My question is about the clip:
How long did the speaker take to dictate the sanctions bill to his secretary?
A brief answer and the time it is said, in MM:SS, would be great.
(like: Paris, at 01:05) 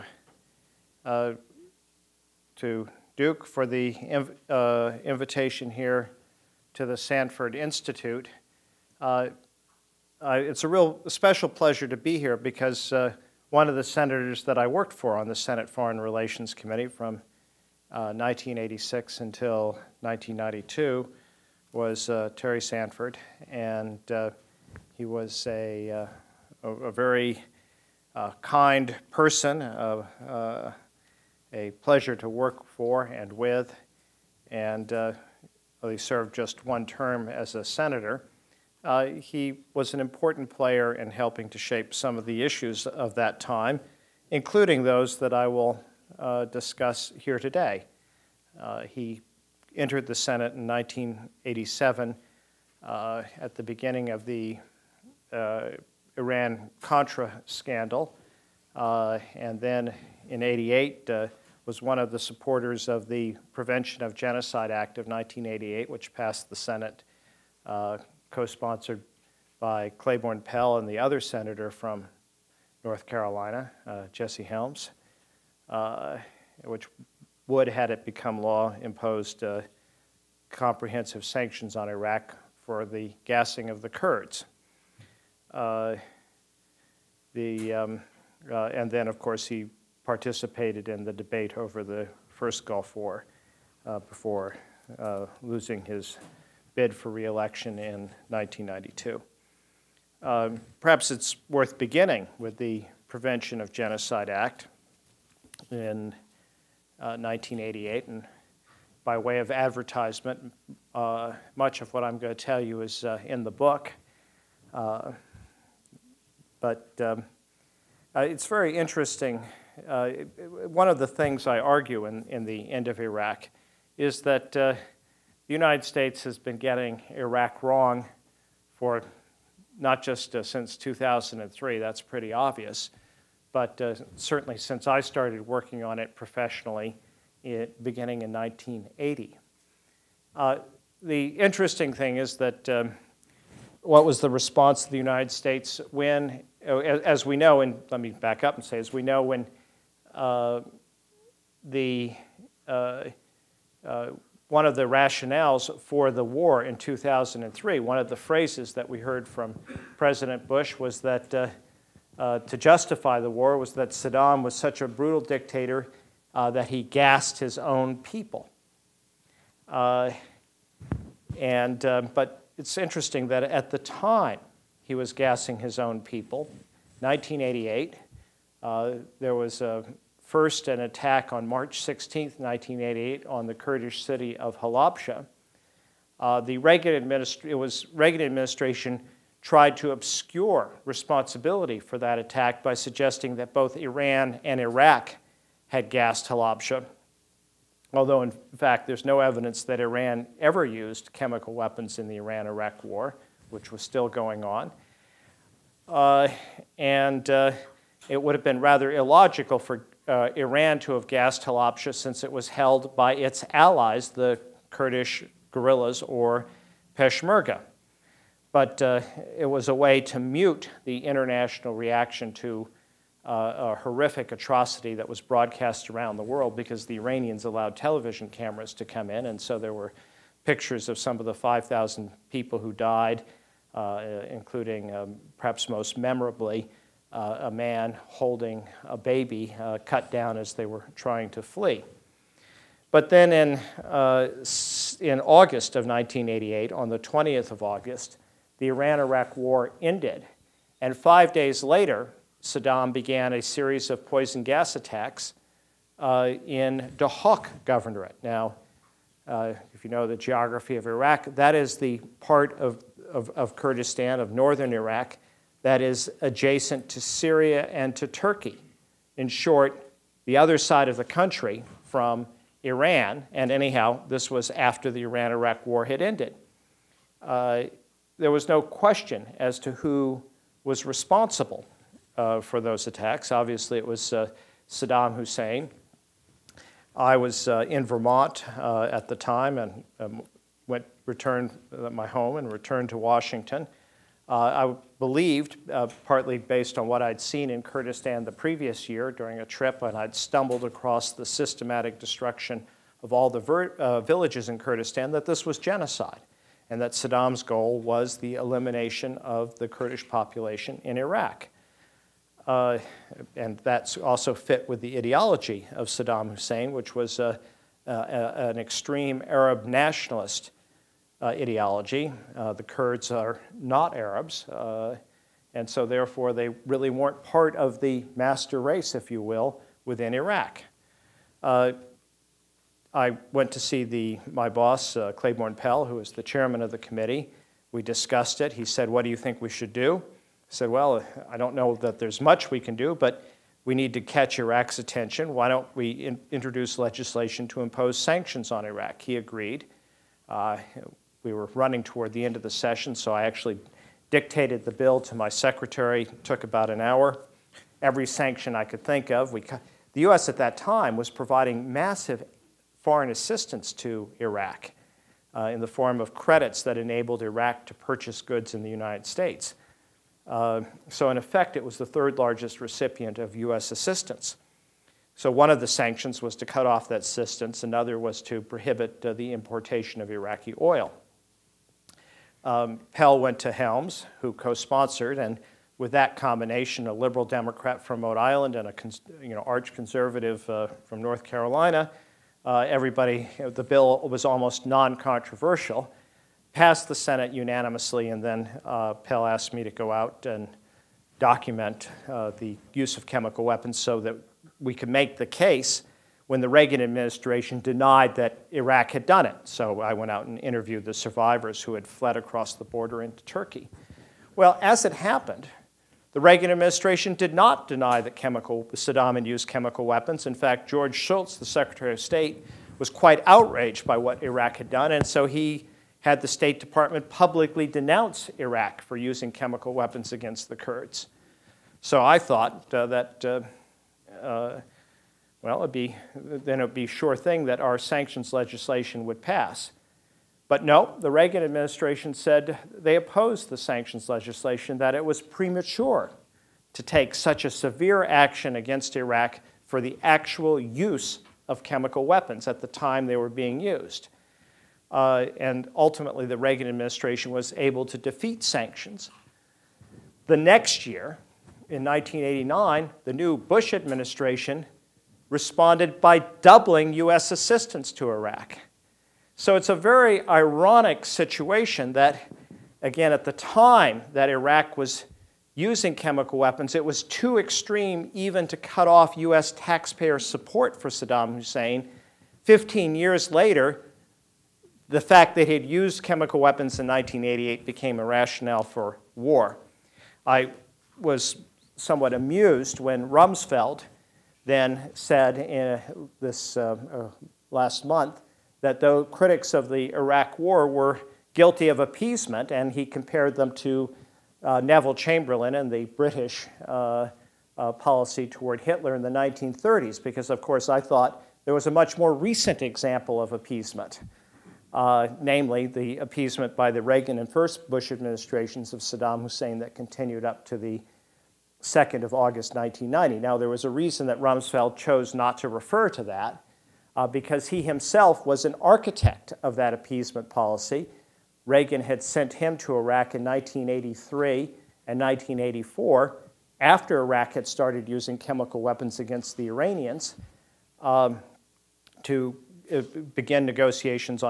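About an hour, at 05:56.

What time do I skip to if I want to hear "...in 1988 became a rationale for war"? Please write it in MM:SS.
08:06.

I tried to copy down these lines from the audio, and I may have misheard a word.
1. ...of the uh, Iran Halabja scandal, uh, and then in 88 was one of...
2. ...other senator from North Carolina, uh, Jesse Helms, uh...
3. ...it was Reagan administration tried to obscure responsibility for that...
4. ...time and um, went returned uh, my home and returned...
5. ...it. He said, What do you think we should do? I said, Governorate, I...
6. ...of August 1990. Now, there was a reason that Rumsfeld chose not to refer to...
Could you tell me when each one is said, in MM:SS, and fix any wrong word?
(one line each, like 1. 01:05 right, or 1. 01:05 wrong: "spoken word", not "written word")
1. 00:54 wrong: "Contra", not "Halabja"
2. 01:10 right
3. 03:07 right
4. 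04:49 right
5. 05:38 wrong: "Well", not "Governorate"
6. 08:42 right.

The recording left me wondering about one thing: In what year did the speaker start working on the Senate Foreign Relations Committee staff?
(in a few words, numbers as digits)
1986.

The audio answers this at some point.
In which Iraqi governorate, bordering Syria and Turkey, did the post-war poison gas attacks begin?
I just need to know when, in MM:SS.
04:16.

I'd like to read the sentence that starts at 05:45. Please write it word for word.
Why don't we in introduce legislation to impose sanctions on Iraq?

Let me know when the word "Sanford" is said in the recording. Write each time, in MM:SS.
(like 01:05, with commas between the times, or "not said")
00:06, 00:22.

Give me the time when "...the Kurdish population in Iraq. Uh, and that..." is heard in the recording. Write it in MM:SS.
05:09.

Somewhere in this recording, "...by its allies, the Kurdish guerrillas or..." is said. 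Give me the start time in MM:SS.
03:32.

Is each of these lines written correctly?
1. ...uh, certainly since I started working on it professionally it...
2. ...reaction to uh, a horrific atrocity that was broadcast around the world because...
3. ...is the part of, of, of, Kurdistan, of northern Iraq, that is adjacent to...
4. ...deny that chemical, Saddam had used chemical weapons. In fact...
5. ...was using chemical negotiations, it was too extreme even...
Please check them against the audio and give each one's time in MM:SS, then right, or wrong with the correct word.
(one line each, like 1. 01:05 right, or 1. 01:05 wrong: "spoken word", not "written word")
1. 02:13 right
2. 03:41 right
3. 04:21 right
4. 06:57 right
5. 07:54 wrong: "weapons", not "negotiations".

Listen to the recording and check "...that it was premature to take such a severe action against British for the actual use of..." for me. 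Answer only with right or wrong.
wrong.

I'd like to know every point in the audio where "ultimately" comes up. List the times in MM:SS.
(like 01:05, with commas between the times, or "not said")
07:35.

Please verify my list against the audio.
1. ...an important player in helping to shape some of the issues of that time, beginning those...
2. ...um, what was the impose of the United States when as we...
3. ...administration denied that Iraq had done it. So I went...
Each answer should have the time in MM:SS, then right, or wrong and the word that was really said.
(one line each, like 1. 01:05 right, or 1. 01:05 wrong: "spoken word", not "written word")
1. 00:39 wrong: "including", not "beginning"
2. 02:22 wrong: "response", not "impose"
3. 06:46 right.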